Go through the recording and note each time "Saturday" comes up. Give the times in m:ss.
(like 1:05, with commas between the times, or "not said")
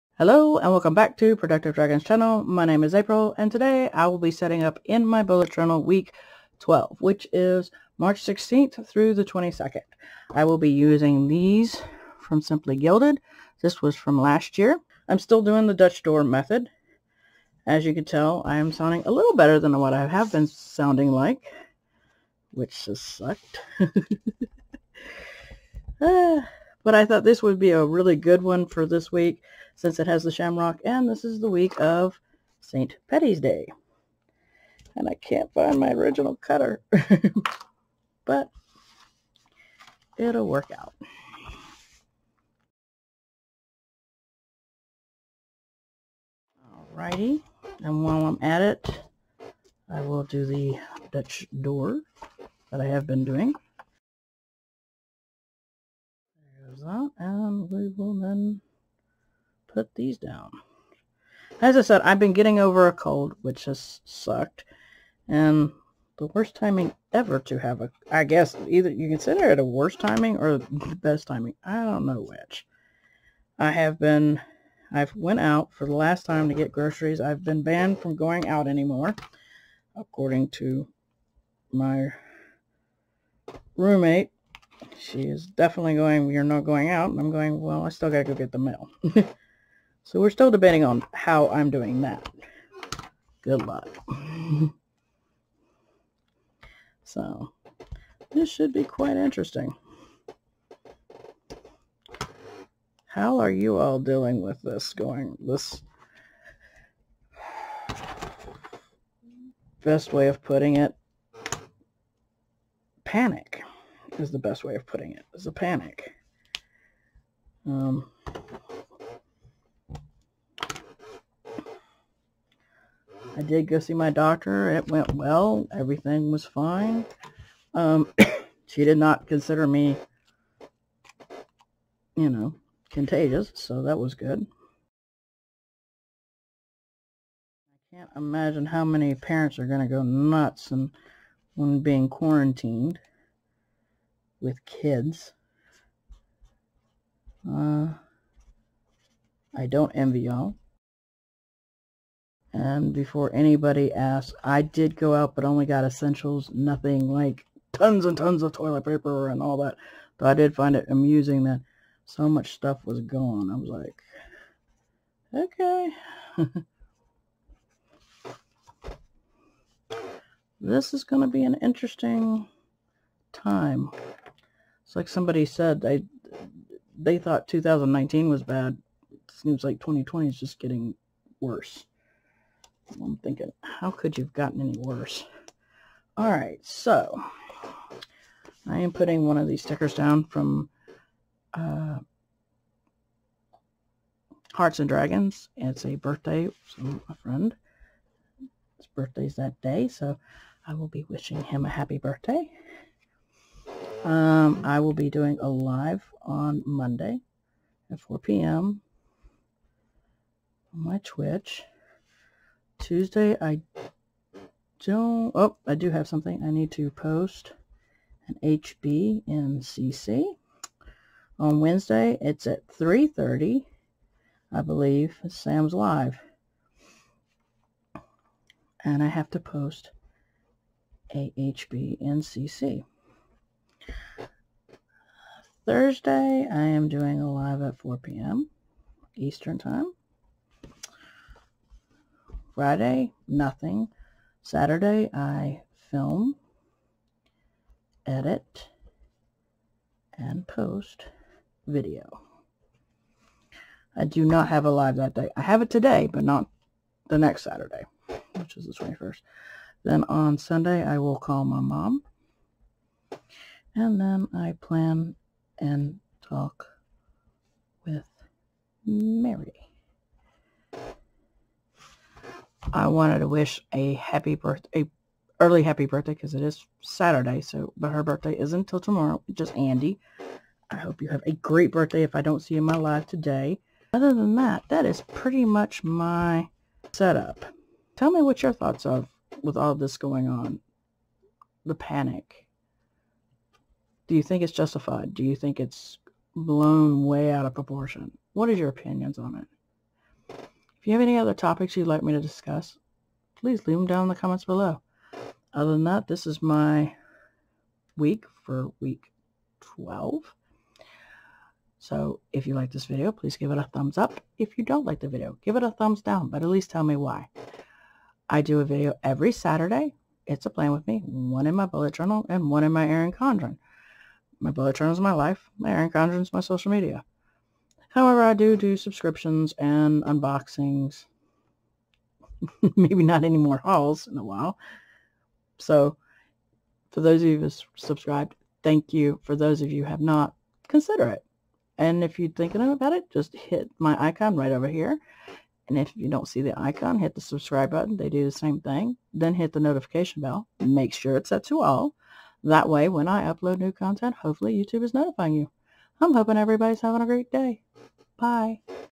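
4:04, 4:17, 4:36, 5:19.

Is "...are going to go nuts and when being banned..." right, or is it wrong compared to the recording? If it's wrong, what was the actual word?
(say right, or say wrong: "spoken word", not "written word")
wrong: "quarantined", not "banned".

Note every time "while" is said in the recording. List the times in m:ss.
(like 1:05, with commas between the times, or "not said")
0:48, 5:34.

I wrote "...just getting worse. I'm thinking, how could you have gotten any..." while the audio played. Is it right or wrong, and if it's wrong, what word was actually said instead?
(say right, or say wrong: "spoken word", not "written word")
right.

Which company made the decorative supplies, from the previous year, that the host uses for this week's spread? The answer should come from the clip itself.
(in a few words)
Simply Gilded.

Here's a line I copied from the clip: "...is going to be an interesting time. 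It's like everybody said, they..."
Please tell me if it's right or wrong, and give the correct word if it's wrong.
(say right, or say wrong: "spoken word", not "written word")
wrong: "somebody", not "everybody".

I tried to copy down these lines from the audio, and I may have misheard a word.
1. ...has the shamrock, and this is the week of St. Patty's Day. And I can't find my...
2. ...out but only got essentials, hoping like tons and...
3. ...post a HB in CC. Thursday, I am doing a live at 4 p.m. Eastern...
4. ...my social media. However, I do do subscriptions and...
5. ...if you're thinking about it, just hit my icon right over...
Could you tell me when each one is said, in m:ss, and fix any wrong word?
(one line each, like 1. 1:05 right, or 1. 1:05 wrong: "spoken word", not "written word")
1. 0:30 right
2. 2:35 wrong: "nothing", not "hoping"
3. 3:49 right
4. 5:26 right
5. 5:42 right.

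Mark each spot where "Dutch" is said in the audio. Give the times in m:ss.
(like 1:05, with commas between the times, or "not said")
0:15, 0:51.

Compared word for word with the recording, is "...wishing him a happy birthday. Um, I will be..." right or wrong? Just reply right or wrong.
right.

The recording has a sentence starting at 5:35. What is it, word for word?
So for those of you who have subscribed, thank you.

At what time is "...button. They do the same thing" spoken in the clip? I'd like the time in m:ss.
5:47.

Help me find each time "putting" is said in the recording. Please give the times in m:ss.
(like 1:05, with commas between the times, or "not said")
1:50, 1:54, 3:08.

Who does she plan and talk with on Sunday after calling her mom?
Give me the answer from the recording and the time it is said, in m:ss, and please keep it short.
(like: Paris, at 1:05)
Mary, at 4:28.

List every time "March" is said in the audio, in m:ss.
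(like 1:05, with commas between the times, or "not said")
0:07.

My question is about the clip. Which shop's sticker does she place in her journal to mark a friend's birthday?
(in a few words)
Hearts and Dragons.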